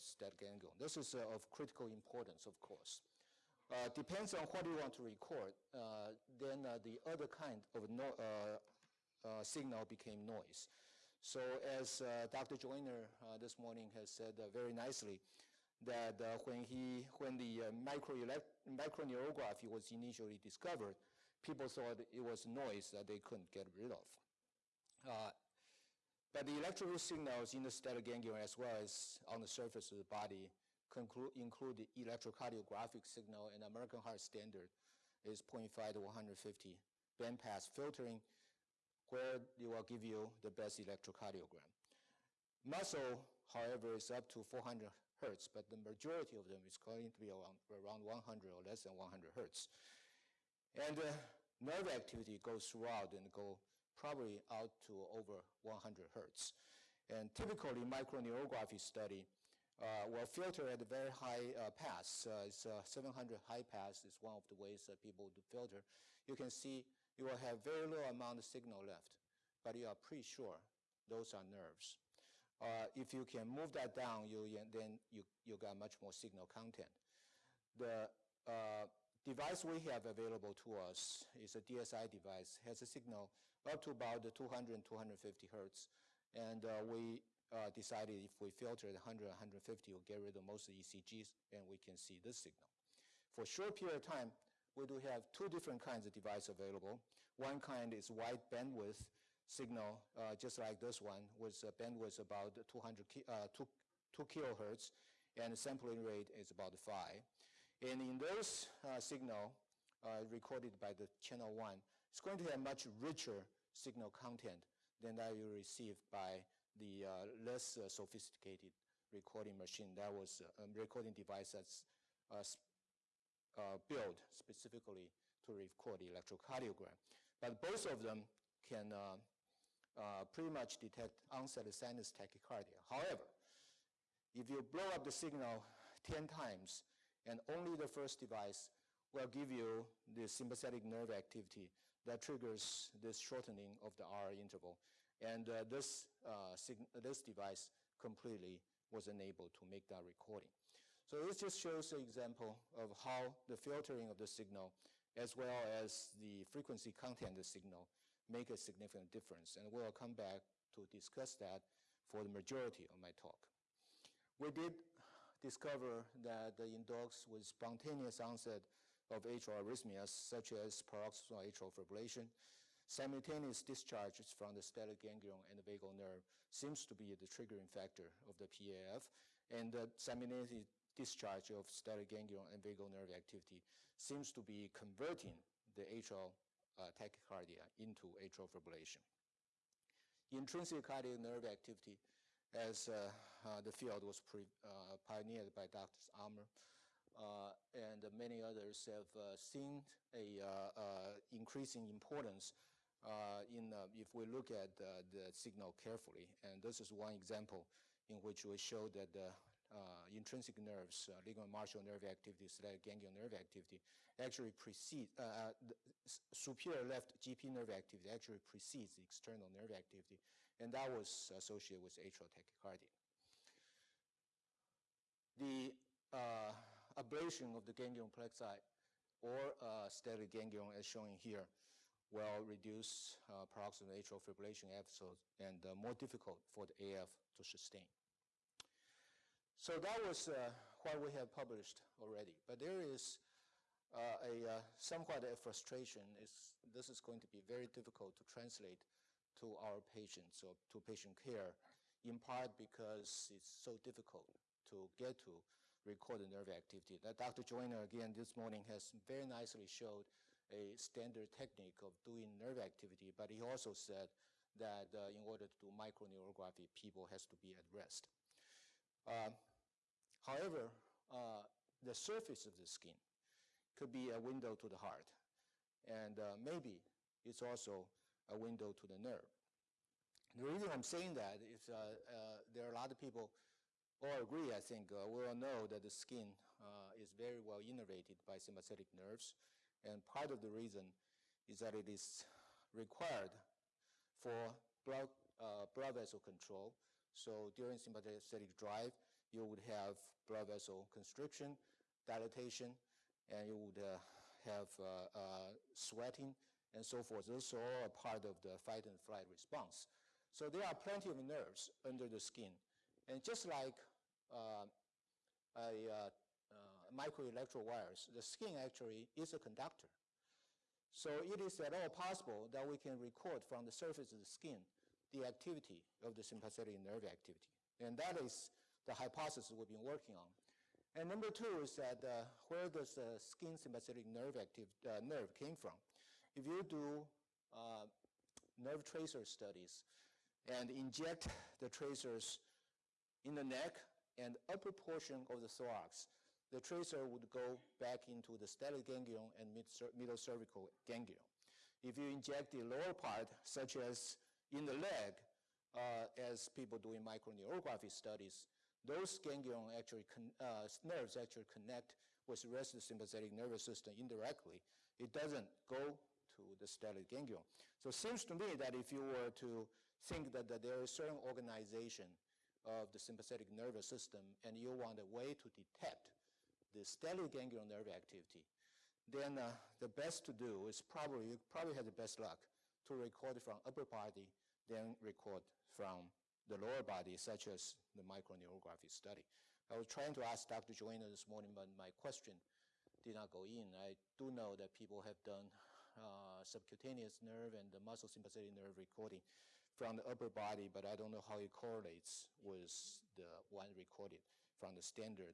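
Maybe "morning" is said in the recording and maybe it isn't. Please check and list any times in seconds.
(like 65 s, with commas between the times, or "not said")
13 s, 258 s, 391 s.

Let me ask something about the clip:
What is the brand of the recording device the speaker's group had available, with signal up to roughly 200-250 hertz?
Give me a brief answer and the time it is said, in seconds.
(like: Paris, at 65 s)
DSI, at 81 s.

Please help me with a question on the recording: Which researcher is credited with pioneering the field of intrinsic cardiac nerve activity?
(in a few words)
Dr. Armour.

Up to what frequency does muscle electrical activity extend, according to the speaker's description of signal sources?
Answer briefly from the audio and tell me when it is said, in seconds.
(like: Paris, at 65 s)
400 hertz, at 44 s.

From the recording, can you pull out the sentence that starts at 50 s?
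And uh, nerve activity goes throughout and go probably out to over 100 hertz.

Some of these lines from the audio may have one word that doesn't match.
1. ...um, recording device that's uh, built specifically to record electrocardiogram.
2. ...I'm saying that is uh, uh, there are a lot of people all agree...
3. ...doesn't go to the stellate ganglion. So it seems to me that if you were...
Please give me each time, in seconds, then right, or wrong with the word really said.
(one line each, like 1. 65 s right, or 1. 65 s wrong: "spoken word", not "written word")
1. 120 s right
2. 280 s right
3. 365 s right.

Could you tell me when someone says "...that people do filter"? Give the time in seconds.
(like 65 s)
64 s.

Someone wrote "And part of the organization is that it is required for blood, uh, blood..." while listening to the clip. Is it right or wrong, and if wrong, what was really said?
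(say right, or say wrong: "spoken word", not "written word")
wrong: "reason", not "organization".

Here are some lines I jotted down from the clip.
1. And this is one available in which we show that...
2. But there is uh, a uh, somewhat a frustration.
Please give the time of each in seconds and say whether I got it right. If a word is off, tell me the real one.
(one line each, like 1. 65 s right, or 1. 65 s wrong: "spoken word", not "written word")
1. 206 s wrong: "example", not "available"
2. 242 s right.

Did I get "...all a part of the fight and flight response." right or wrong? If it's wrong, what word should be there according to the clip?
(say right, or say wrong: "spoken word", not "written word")
right.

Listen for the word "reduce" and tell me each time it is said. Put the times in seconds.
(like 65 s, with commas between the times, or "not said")
232 s.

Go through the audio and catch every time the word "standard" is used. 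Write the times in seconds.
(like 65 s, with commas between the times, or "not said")
34 s, 260 s, 404 s.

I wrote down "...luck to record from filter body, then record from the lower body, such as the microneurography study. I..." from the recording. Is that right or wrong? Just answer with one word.
wrong.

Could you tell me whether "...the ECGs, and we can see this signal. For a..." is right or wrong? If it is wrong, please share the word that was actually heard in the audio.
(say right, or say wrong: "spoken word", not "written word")
right.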